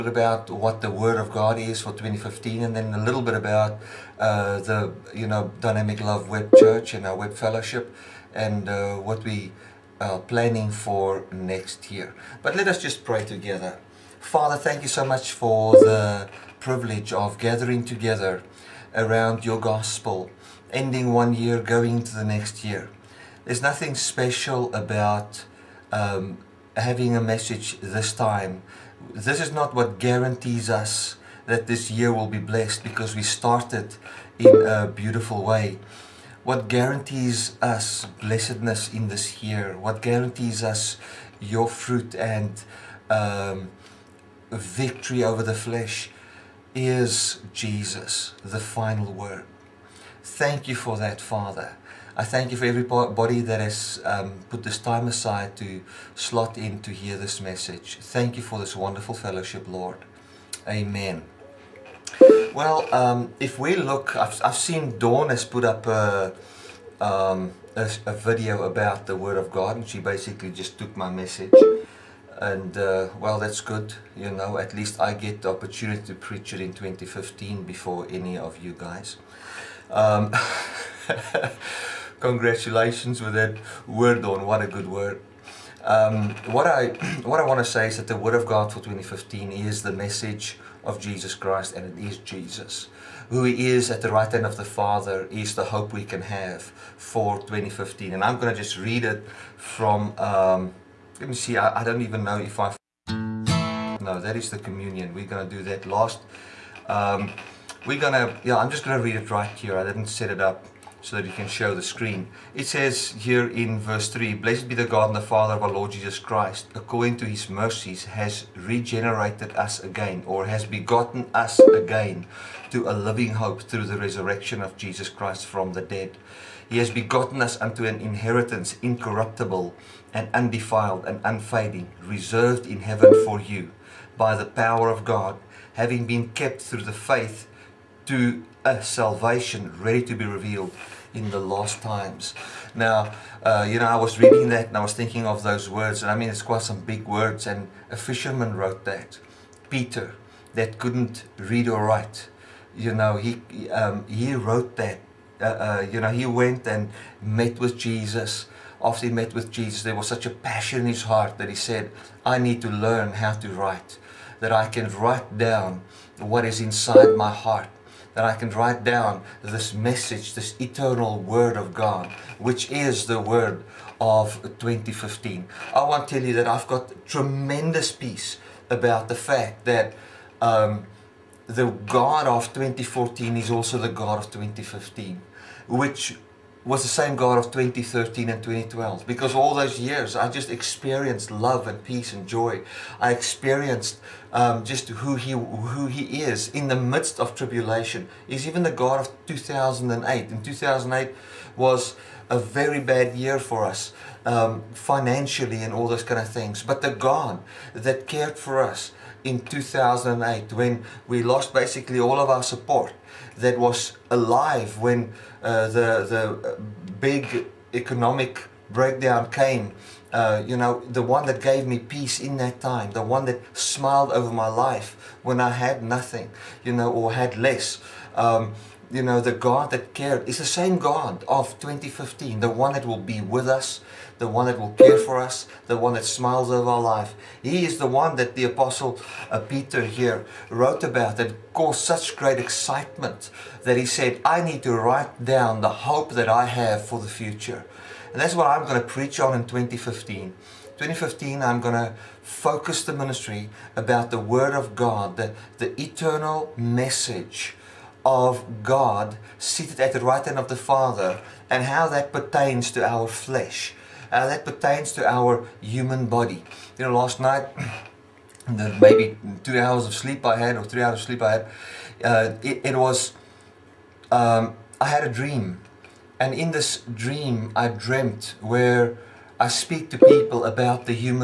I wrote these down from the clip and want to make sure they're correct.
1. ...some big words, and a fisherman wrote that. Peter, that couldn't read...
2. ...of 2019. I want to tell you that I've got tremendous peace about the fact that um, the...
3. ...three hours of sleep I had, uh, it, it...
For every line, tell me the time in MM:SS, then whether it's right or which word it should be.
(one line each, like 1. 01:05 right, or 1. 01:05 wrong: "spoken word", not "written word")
1. 02:26 right
2. 02:53 wrong: "2015", not "2019"
3. 04:30 right.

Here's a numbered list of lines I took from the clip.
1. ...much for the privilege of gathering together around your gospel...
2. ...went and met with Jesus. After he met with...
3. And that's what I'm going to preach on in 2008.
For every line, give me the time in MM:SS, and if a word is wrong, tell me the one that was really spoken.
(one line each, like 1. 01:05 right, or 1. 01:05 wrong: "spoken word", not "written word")
1. 00:15 right
2. 02:36 right
3. 04:08 wrong: "2015", not "2008".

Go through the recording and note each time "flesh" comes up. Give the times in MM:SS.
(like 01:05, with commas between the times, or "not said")
00:45, 04:23.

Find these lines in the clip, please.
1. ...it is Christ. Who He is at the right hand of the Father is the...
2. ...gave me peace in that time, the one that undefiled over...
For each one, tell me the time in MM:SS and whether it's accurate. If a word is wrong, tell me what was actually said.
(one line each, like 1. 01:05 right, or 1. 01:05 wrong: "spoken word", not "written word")
1. 01:31 wrong: "Jesus", not "Christ"
2. 03:41 wrong: "smiled", not "undefiled".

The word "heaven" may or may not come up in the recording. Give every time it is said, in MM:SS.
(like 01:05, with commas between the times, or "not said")
02:12.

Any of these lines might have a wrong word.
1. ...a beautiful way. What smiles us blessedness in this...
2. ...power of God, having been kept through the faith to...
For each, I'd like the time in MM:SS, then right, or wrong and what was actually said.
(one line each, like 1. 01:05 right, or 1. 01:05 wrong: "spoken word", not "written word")
1. 00:34 wrong: "guarantees", not "smiles"
2. 02:14 right.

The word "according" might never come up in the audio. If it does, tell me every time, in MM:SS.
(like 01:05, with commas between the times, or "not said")
01:56.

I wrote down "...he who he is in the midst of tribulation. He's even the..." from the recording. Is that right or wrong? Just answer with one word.
right.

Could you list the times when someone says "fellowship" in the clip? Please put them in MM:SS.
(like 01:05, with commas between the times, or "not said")
00:07, 00:59.